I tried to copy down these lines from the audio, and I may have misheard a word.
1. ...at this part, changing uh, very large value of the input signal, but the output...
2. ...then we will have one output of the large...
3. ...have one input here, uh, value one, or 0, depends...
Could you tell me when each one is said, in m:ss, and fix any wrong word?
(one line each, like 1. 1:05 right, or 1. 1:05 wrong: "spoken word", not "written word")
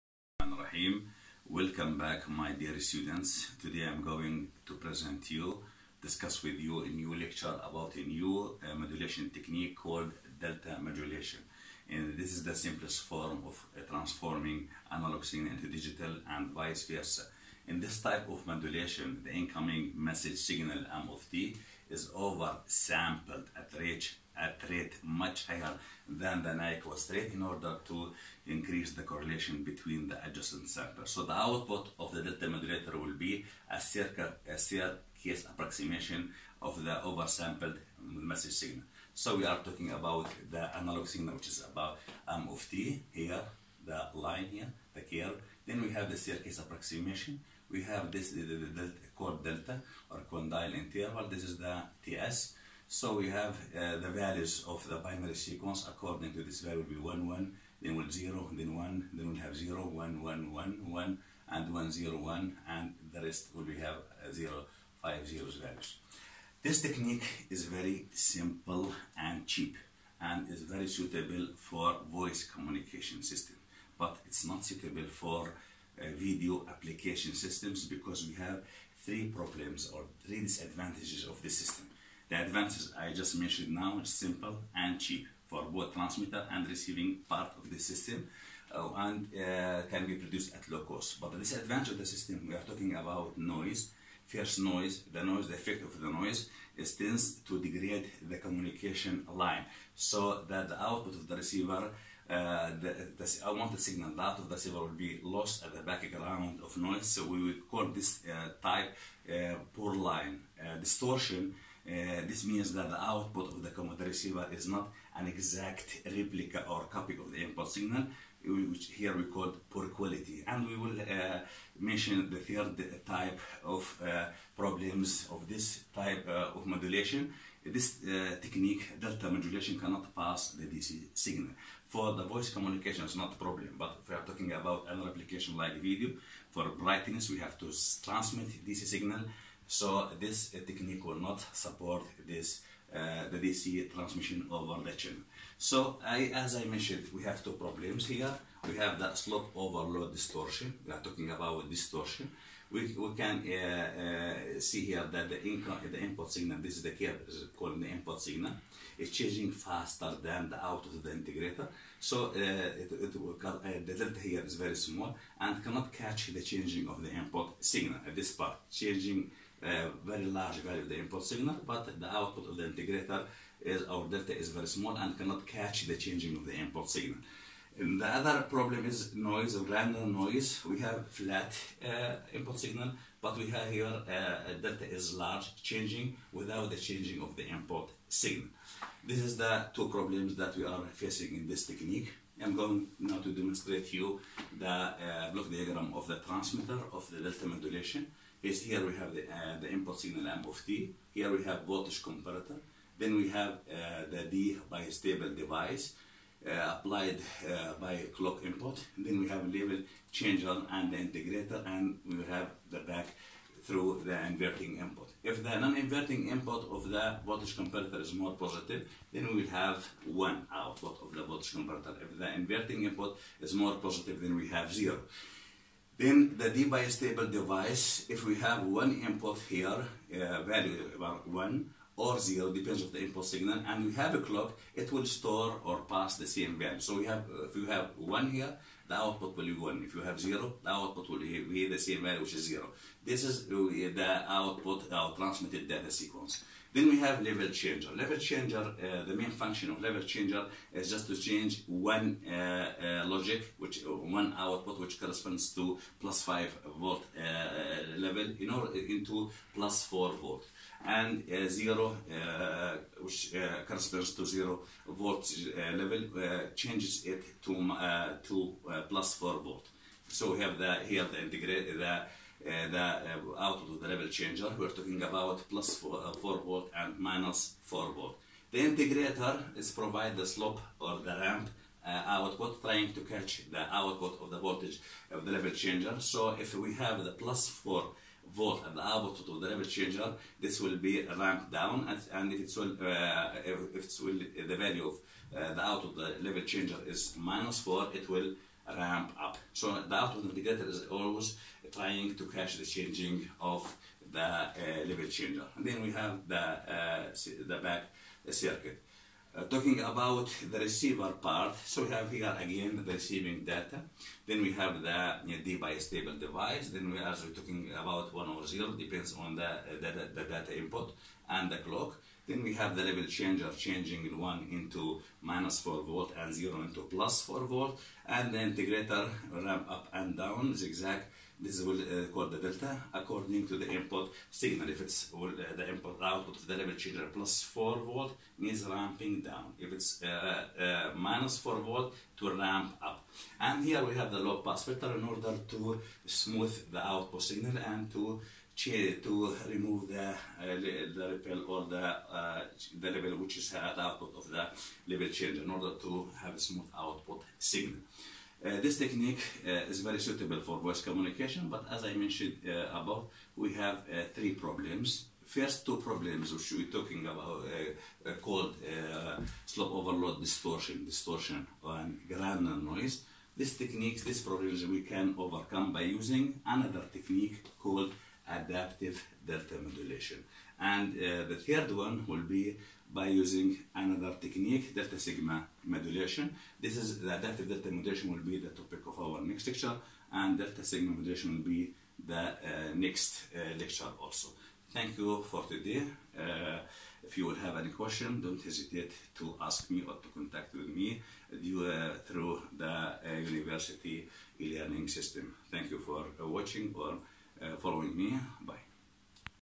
1. 2:48 right
2. 3:39 wrong: "voltage", not "large"
3. 3:48 right.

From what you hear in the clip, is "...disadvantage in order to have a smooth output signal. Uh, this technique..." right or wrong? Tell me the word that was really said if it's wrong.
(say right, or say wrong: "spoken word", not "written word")
wrong: "change", not "disadvantage".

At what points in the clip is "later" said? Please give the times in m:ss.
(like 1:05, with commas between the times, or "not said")
not said.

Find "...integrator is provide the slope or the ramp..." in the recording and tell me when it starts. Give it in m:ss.
4:38.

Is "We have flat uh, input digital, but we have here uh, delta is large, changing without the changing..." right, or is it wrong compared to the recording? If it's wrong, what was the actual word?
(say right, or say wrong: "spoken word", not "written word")
wrong: "signal", not "digital".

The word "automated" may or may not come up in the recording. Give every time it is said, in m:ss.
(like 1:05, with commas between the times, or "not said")
not said.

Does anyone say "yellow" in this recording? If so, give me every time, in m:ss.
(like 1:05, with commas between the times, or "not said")
not said.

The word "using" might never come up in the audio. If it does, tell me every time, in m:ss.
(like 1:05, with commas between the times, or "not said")
6:15, 6:23.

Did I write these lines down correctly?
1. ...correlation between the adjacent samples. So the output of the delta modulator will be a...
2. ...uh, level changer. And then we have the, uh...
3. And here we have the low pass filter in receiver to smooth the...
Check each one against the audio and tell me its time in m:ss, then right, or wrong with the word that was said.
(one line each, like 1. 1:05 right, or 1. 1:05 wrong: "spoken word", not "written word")
1. 0:29 right
2. 5:04 right
3. 5:43 wrong: "order", not "receiver".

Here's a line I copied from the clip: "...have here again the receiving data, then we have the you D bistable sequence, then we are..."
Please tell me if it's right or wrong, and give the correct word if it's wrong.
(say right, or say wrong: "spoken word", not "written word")
wrong: "device", not "sequence".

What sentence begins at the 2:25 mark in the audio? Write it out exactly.
So I, as I mentioned, we have two problems here.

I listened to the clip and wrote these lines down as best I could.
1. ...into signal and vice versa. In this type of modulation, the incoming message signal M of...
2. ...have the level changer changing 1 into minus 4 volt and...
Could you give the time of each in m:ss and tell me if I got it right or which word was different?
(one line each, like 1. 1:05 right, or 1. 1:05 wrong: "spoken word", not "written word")
1. 0:15 wrong: "digital", not "signal"
2. 5:22 right.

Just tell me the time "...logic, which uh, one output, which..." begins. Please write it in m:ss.
4:13.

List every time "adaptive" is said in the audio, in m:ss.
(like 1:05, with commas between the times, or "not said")
6:18, 6:27.